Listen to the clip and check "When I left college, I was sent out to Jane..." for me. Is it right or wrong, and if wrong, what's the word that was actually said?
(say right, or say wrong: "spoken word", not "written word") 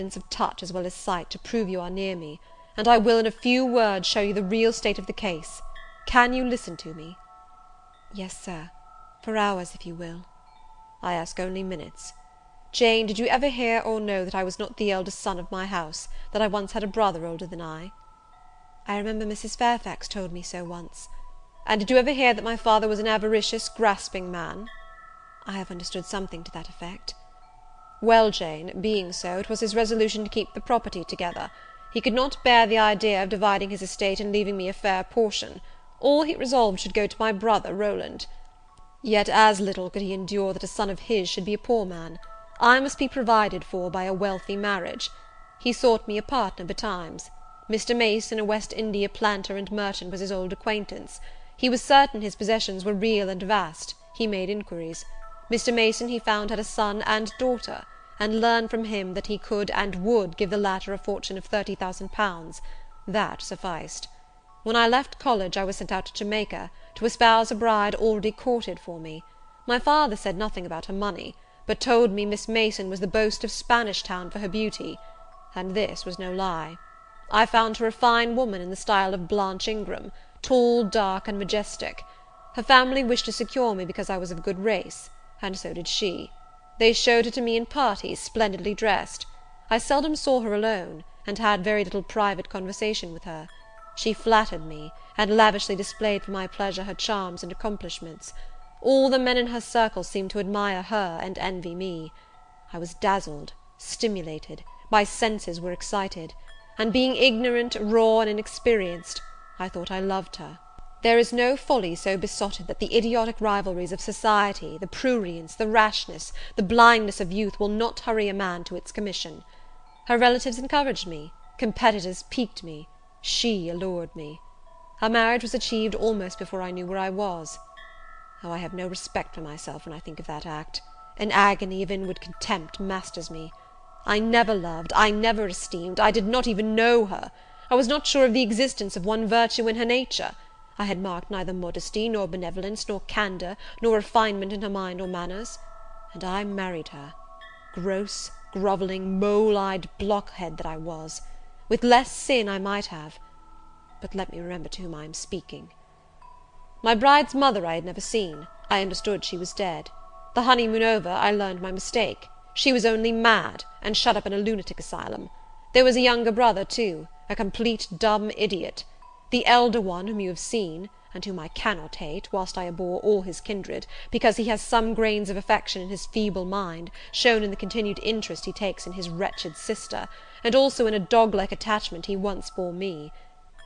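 wrong: "Jamaica", not "Jane".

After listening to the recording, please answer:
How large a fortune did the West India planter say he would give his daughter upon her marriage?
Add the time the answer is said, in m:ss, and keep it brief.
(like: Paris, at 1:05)
30,000 pounds, at 1:01.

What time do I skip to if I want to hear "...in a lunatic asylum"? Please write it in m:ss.
2:44.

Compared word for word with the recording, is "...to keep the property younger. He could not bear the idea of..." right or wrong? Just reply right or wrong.
wrong.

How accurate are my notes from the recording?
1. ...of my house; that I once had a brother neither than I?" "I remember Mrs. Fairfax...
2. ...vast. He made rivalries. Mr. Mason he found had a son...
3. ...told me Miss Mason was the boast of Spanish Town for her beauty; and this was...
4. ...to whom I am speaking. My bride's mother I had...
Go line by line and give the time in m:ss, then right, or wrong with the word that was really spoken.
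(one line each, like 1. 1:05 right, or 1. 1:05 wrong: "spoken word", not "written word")
1. 0:15 wrong: "older", not "neither"
2. 0:53 wrong: "inquiries", not "rivalries"
3. 1:11 right
4. 2:34 right.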